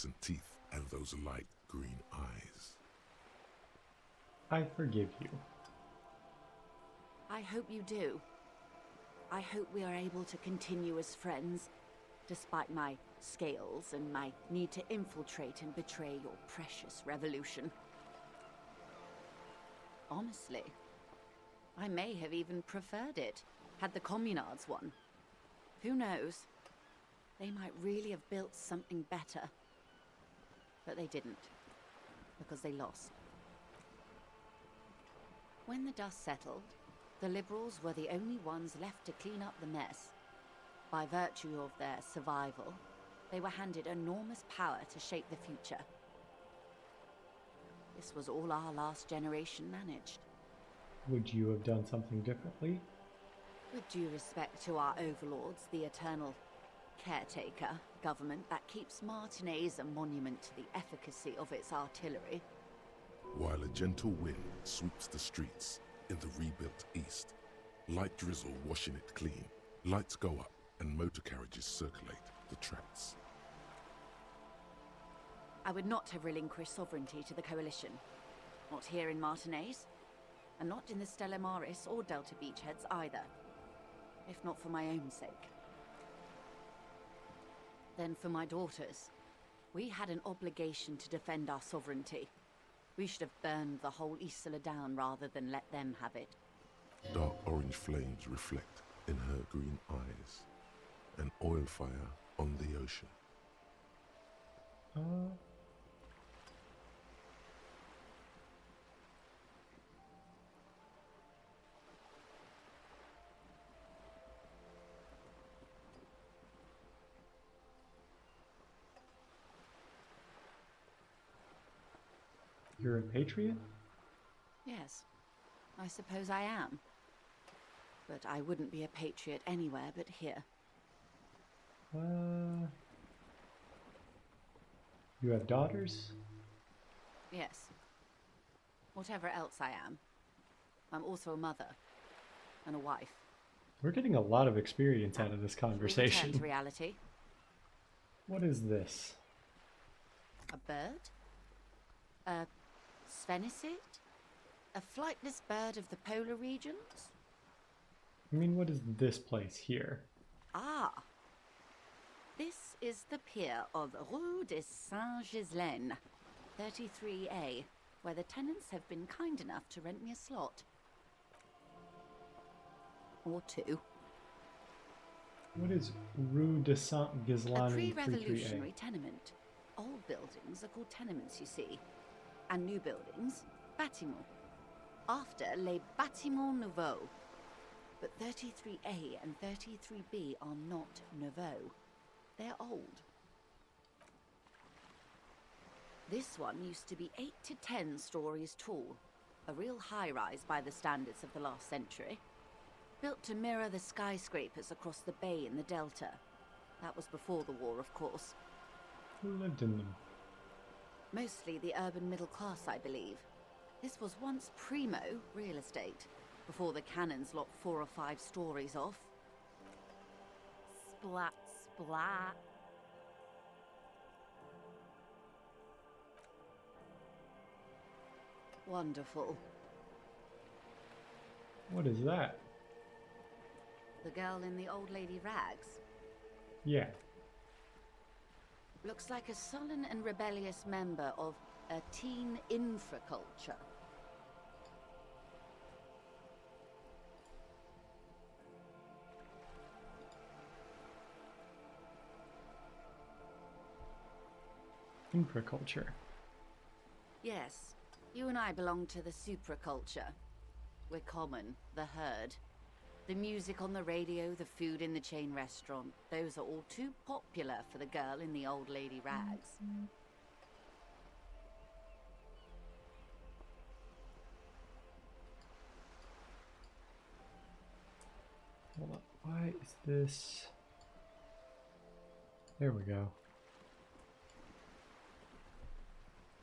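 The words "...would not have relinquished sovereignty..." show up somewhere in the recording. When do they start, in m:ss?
1:15.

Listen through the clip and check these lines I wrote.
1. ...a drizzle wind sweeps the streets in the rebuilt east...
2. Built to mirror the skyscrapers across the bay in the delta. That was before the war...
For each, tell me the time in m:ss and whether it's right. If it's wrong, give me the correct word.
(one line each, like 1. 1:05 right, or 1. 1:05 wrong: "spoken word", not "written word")
1. 1:03 wrong: "gentle", not "drizzle"
2. 3:23 right.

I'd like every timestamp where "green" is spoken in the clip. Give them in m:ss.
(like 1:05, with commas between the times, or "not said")
0:01, 1:39.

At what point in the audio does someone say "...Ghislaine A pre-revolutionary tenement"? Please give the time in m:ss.
2:57.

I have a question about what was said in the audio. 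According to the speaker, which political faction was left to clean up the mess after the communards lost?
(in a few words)
The Liberals.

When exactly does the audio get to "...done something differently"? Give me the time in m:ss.
0:51.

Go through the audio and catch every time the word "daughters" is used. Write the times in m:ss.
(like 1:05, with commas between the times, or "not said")
1:28, 2:15.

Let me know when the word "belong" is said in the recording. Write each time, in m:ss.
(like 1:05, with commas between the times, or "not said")
4:18.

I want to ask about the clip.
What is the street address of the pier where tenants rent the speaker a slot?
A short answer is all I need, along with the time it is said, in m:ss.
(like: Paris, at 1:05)
Rue de saint Ghislaine 33A, at 2:44.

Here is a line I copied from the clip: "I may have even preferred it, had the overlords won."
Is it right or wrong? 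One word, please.
wrong.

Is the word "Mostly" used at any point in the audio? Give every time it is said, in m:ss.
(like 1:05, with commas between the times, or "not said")
3:31.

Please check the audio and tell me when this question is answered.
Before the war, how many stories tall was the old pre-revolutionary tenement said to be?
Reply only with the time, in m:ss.
3:17.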